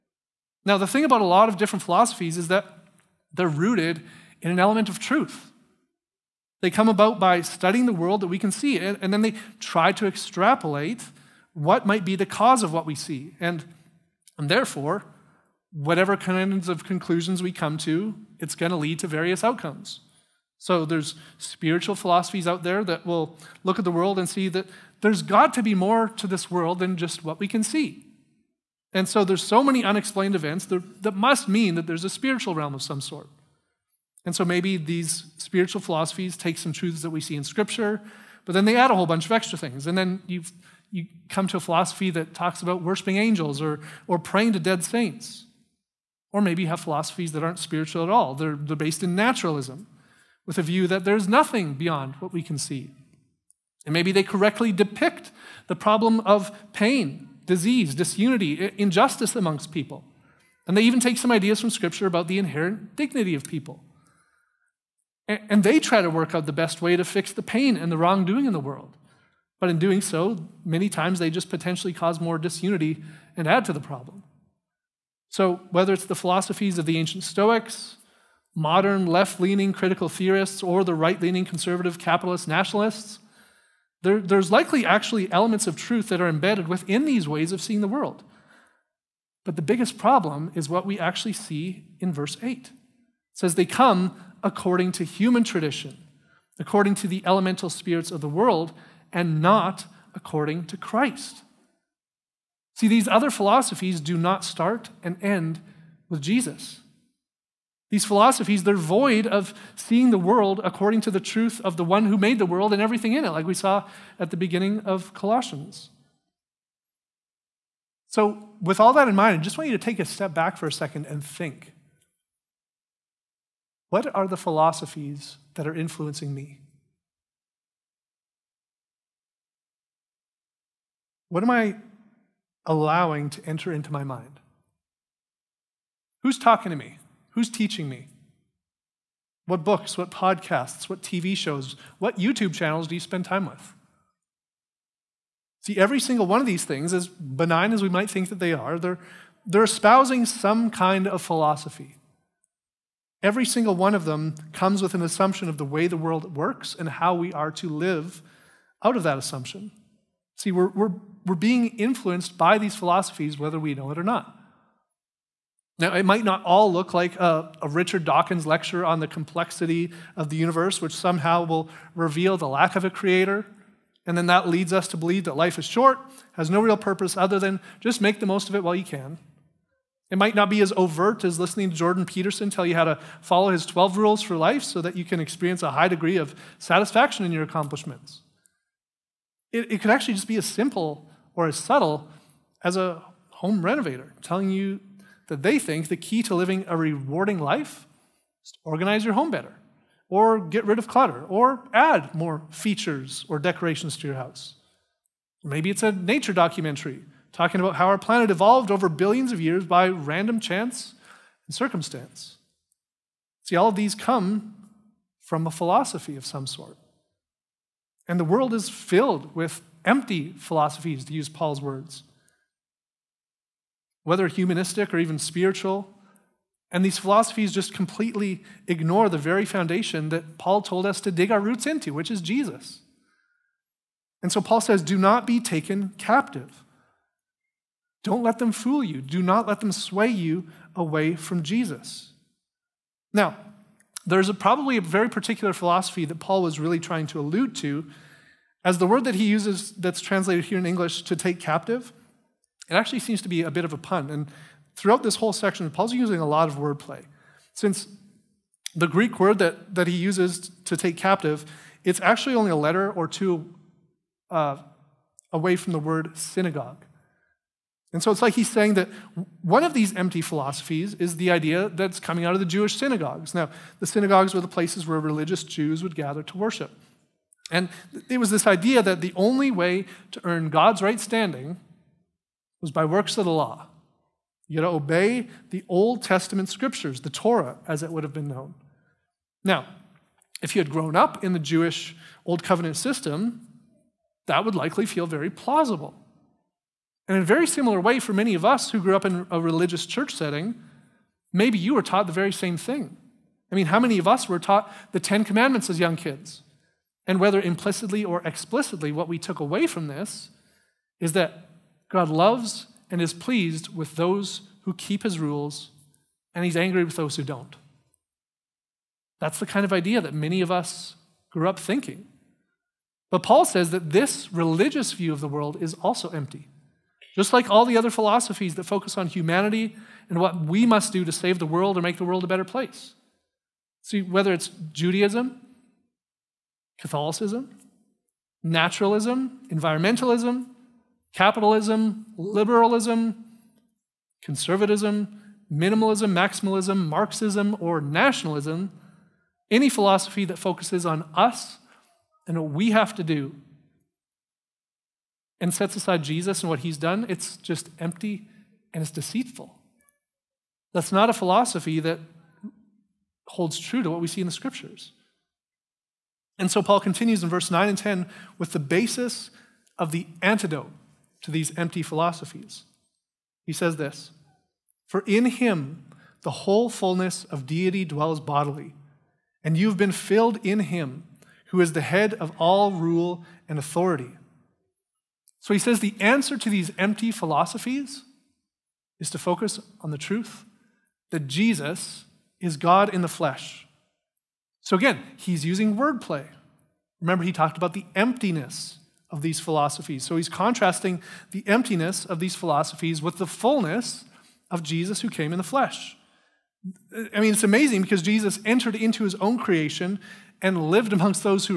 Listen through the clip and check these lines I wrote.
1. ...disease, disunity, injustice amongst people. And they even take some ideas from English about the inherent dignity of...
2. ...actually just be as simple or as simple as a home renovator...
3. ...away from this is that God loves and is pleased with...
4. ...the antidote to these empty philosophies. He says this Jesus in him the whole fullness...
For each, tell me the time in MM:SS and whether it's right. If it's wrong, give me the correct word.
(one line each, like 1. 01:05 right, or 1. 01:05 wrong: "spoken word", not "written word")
1. 00:57 wrong: "Scripture", not "English"
2. 03:09 wrong: "subtle", not "simple"
3. 05:09 right
4. 06:09 wrong: "For", not "Jesus".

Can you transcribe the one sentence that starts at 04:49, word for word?
Now, if you had grown up in the Jewish Old Covenant system, that would likely feel very plausible.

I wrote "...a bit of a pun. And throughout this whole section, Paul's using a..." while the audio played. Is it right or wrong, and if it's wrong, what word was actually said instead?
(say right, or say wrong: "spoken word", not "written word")
right.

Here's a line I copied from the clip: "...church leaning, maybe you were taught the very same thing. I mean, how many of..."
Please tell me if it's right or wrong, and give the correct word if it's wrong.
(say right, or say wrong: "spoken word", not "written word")
wrong: "setting", not "leaning".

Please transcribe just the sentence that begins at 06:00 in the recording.
That's not a philosophy that holds true to what we see in the scriptures.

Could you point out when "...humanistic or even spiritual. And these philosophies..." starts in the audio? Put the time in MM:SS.
03:44.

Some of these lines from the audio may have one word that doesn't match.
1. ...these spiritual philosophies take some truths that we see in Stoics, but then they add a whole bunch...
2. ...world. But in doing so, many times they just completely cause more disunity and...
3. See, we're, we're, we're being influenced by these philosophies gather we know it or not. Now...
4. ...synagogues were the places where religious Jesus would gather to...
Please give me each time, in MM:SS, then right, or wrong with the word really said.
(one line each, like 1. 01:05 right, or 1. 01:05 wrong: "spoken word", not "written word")
1. 00:34 wrong: "Scripture", not "Stoics"
2. 01:08 wrong: "potentially", not "completely"
3. 02:40 wrong: "whether", not "gather"
4. 04:33 wrong: "Jews", not "Jesus".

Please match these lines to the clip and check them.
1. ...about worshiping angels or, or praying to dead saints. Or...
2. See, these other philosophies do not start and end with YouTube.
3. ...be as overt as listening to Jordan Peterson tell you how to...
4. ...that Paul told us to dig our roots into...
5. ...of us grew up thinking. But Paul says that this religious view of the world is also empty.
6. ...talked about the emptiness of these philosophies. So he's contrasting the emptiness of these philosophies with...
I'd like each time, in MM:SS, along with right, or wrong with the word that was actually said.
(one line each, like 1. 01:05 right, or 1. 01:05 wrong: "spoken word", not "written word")
1. 00:42 right
2. 01:42 wrong: "Jesus", not "YouTube"
3. 03:00 right
4. 03:50 right
5. 05:20 right
6. 06:37 right.